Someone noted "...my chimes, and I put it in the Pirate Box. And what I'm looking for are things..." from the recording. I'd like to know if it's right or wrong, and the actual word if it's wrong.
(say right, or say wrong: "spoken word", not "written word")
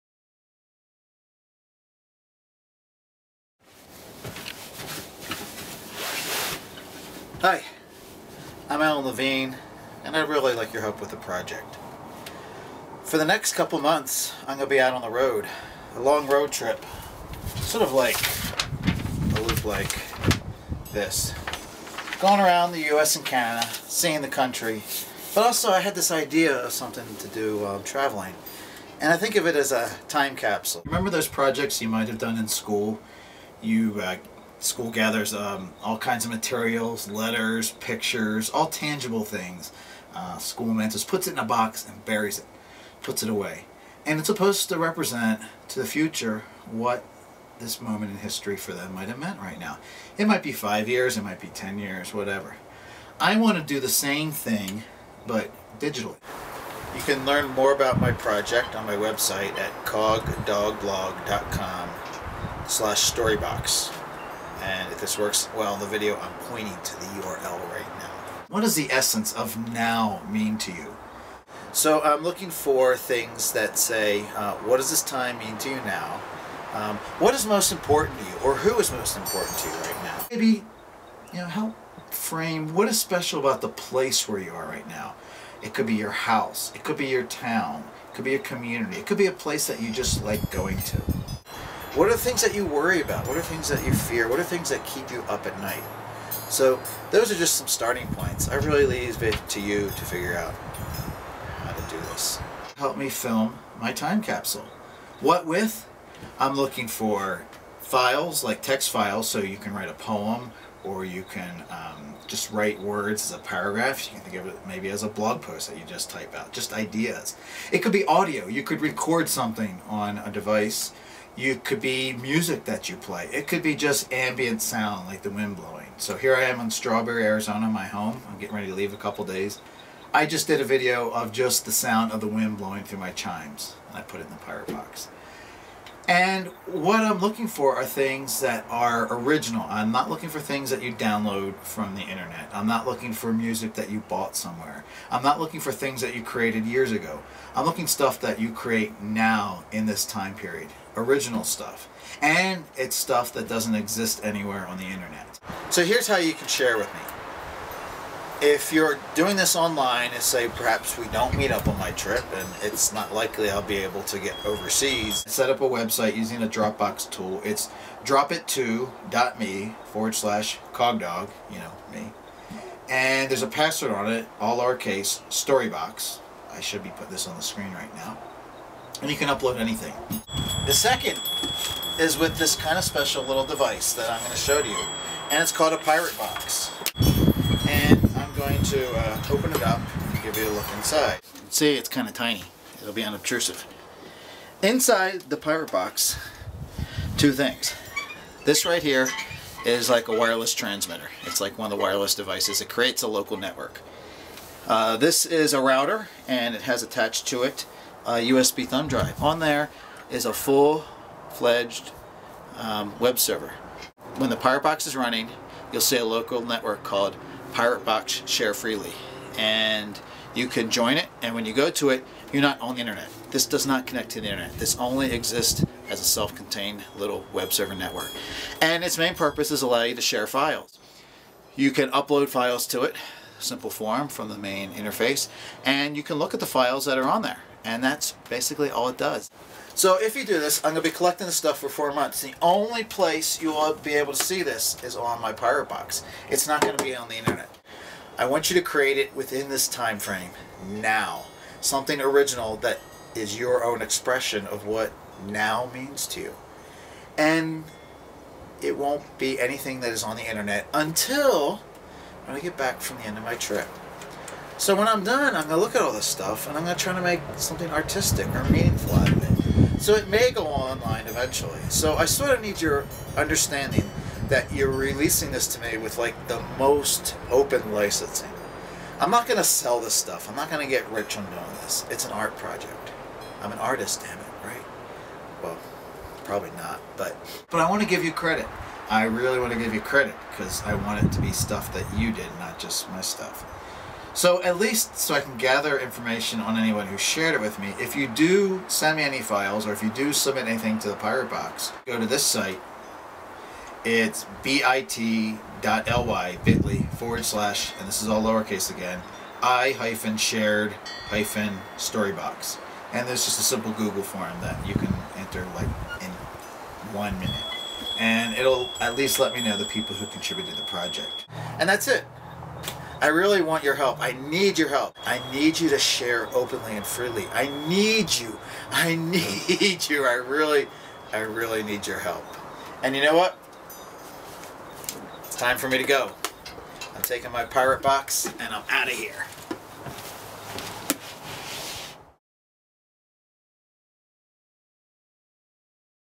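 right.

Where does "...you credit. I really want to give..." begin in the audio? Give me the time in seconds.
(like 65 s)
288 s.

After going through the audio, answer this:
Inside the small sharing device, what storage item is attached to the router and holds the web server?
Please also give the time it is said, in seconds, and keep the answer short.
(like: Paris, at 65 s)
USB thumb drive, at 208 s.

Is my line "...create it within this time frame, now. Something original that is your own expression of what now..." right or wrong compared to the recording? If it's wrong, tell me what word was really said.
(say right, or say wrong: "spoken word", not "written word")
right.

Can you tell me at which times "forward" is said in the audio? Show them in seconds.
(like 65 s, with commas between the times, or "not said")
169 s, 306 s.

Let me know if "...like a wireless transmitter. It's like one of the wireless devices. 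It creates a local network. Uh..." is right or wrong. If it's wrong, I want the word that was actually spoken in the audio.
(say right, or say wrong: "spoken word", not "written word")
right.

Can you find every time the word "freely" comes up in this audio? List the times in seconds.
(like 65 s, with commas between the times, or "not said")
218 s, 326 s.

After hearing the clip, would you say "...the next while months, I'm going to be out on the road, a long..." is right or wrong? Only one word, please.
wrong.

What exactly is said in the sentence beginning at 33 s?
You uh, school gathers um, all kinds of materials, letters, pictures, all tangible things.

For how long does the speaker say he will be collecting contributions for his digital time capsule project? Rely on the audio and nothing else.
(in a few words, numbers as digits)
4 months.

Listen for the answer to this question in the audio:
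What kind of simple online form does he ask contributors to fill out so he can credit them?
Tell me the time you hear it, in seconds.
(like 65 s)
313 s.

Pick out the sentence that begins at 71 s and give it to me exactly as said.
So I'm looking for things that say, uh, what does this time mean to you now?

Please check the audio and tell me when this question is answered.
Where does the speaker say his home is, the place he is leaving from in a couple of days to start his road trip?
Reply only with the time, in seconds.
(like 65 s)
126 s.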